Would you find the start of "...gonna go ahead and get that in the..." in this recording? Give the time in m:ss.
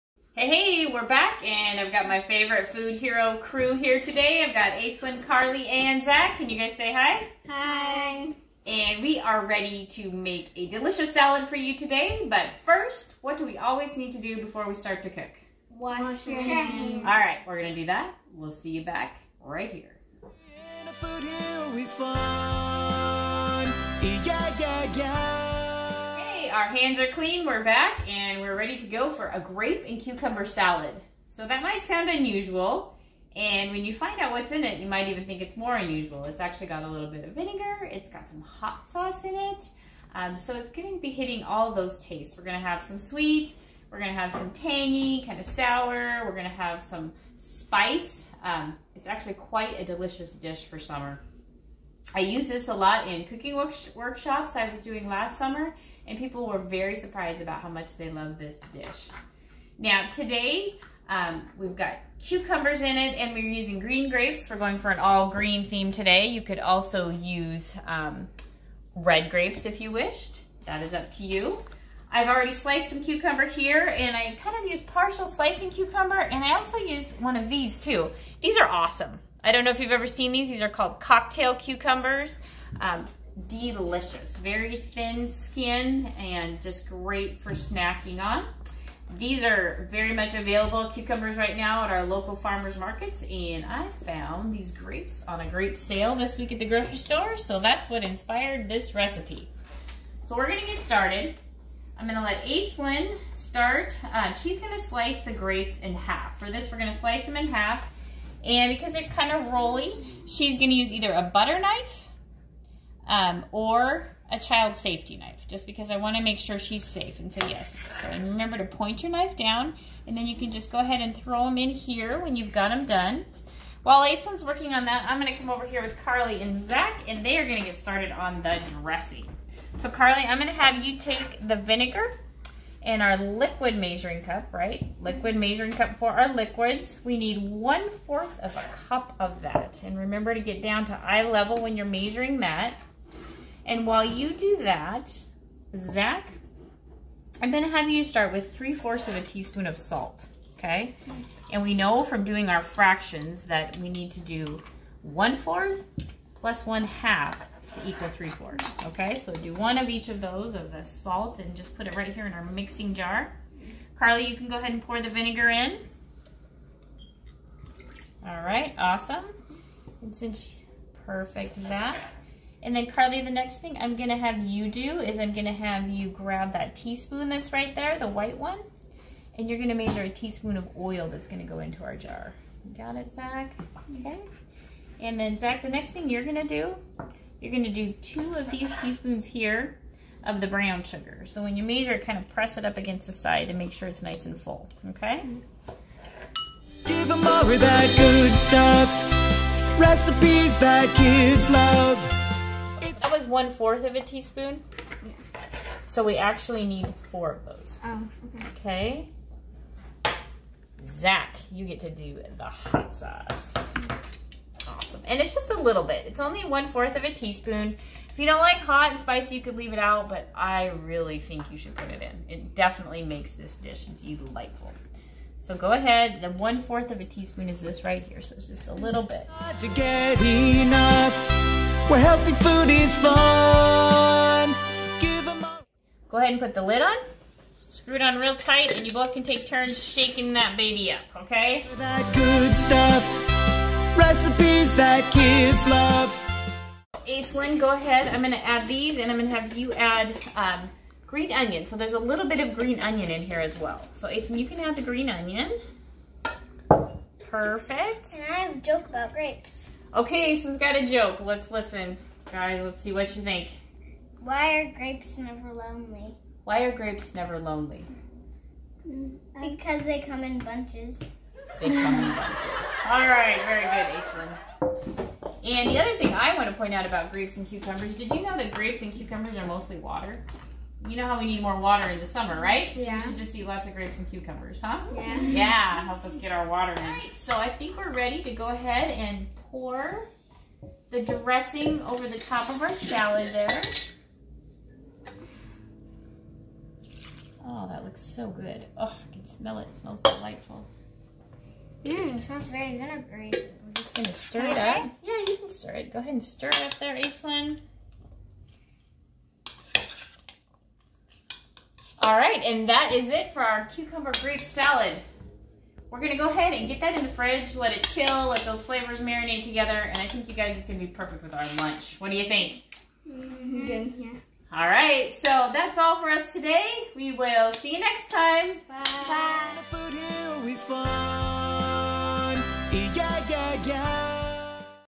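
5:15.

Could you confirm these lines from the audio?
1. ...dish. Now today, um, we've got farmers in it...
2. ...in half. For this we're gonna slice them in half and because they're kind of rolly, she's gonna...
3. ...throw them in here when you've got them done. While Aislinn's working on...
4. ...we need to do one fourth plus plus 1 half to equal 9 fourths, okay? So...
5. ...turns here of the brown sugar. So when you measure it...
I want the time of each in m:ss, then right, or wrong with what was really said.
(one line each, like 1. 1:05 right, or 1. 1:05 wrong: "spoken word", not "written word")
1. 0:58 wrong: "cucumbers", not "farmers"
2. 1:45 right
3. 2:01 right
4. 2:33 wrong: "3", not "9"
5. 3:08 wrong: "teaspoons", not "turns".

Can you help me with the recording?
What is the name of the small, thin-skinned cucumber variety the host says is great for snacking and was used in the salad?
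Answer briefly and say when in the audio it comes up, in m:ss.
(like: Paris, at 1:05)
cocktail cucumbers, at 1:20.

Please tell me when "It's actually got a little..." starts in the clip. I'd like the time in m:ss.
0:36.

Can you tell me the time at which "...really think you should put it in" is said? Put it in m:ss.
3:40.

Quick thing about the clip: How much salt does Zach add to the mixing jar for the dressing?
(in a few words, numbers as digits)
3/4 teaspoon.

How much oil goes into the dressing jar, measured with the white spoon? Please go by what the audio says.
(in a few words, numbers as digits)
1 teaspoon.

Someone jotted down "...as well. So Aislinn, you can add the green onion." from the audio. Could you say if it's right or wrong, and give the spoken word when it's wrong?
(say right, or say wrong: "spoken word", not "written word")
right.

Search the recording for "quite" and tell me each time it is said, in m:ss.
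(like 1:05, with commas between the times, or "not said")
0:49.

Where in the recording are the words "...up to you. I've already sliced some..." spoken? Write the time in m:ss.
1:10.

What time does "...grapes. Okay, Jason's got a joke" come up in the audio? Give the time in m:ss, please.
4:19.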